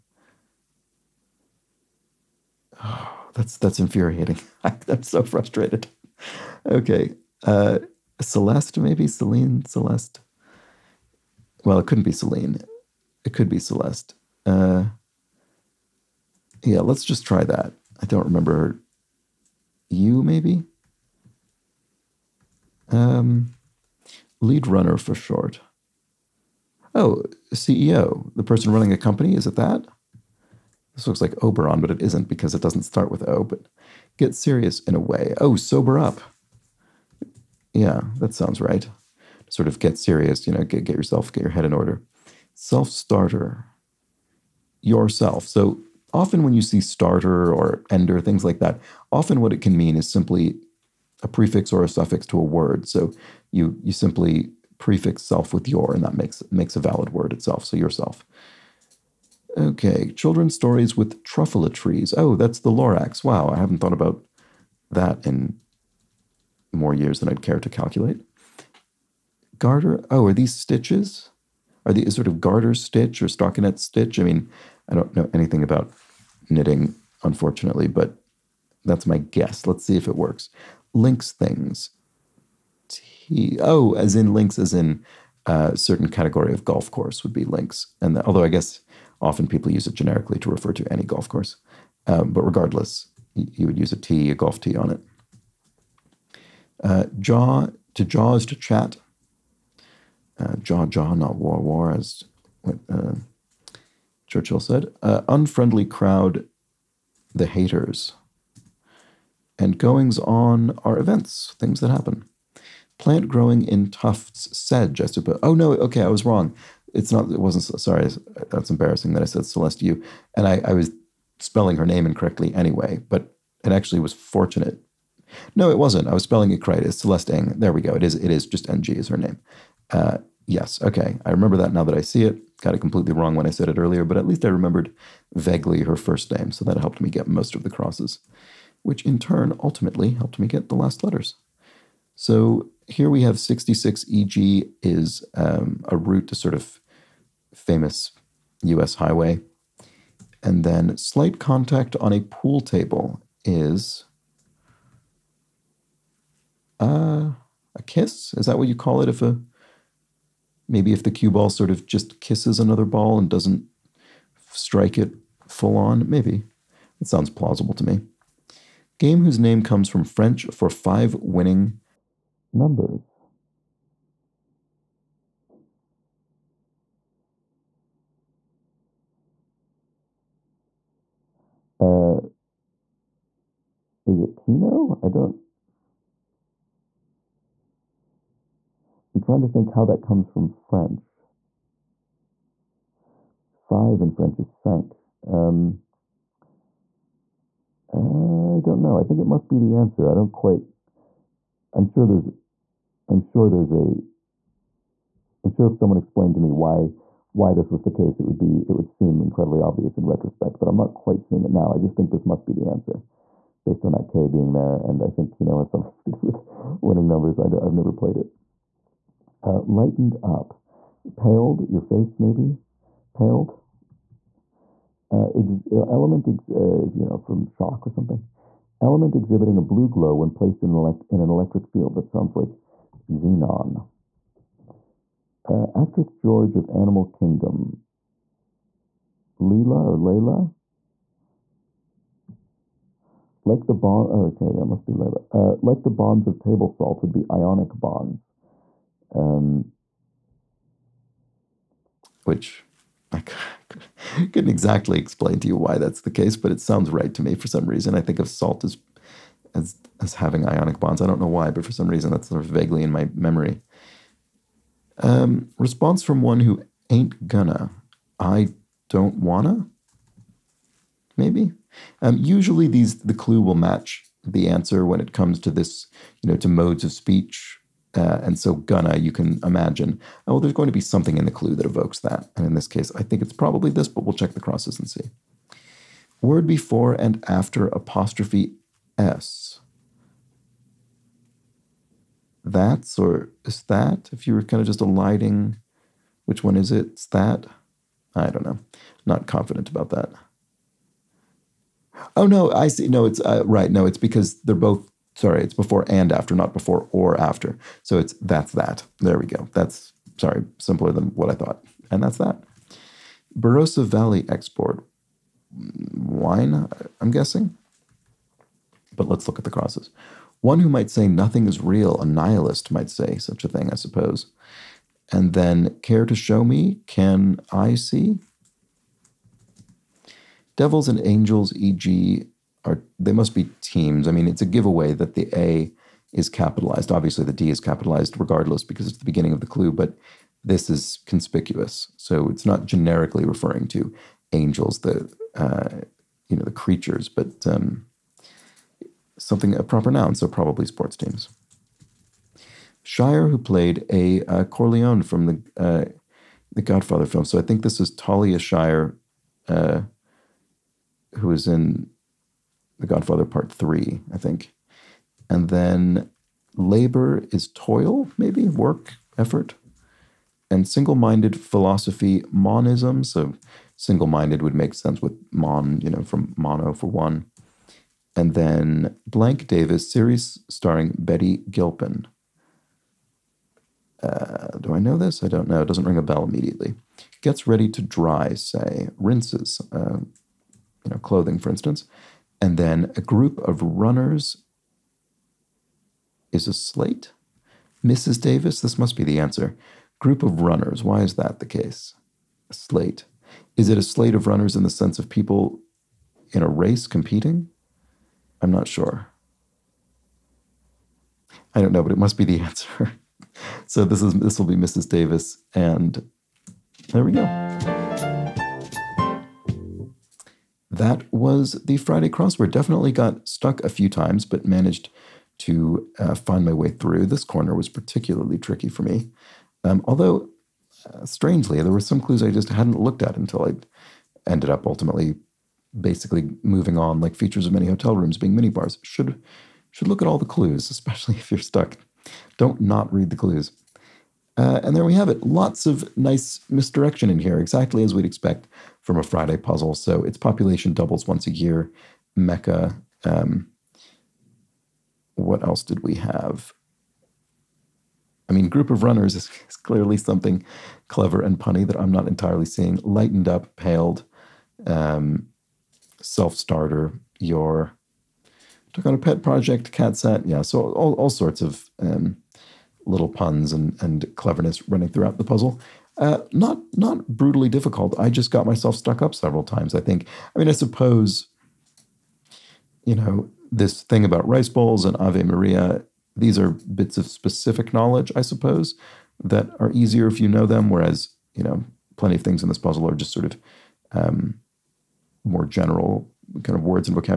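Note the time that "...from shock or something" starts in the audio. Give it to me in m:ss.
3:47.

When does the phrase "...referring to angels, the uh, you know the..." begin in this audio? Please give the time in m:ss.
5:43.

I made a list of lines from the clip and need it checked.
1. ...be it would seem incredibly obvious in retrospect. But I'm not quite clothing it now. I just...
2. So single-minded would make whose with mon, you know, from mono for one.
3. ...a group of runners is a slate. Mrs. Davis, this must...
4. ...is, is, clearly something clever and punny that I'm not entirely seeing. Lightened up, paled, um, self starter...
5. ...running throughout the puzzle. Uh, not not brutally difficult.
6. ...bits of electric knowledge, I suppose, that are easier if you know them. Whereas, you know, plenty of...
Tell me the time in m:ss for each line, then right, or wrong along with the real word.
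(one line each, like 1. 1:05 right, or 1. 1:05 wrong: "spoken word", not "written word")
1. 3:28 wrong: "seeing", not "clothing"
2. 6:13 wrong: "sense", not "whose"
3. 6:32 right
4. 7:39 right
5. 7:54 right
6. 8:06 wrong: "specific", not "electric".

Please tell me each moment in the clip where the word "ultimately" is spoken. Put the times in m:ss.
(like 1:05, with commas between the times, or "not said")
2:19, 7:14.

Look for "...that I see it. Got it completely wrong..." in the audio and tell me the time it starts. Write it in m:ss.
2:11.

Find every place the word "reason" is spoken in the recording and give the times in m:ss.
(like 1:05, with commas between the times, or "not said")
4:17, 4:21.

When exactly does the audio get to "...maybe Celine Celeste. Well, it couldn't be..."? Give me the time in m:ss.
0:08.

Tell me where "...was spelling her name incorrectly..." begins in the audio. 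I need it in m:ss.
2:00.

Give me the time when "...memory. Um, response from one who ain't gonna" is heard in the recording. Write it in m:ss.
4:23.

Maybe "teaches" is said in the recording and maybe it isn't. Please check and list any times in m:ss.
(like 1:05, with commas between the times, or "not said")
not said.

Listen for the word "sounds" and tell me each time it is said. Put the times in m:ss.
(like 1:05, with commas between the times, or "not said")
0:38, 2:47, 3:52, 4:16.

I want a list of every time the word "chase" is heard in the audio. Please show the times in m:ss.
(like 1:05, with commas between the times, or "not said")
not said.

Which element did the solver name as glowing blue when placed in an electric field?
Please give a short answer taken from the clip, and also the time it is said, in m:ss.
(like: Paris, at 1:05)
xenon, at 3:53.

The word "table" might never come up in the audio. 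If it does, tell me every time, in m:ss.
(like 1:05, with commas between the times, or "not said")
2:32, 4:06.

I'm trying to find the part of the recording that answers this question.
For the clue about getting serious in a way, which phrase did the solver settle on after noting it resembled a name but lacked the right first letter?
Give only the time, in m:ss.
0:35.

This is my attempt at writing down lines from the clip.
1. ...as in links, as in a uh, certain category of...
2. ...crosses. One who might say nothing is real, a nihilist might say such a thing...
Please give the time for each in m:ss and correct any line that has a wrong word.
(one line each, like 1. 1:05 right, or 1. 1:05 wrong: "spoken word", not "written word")
1. 1:23 right
2. 5:19 right.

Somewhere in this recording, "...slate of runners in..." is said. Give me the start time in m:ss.
6:43.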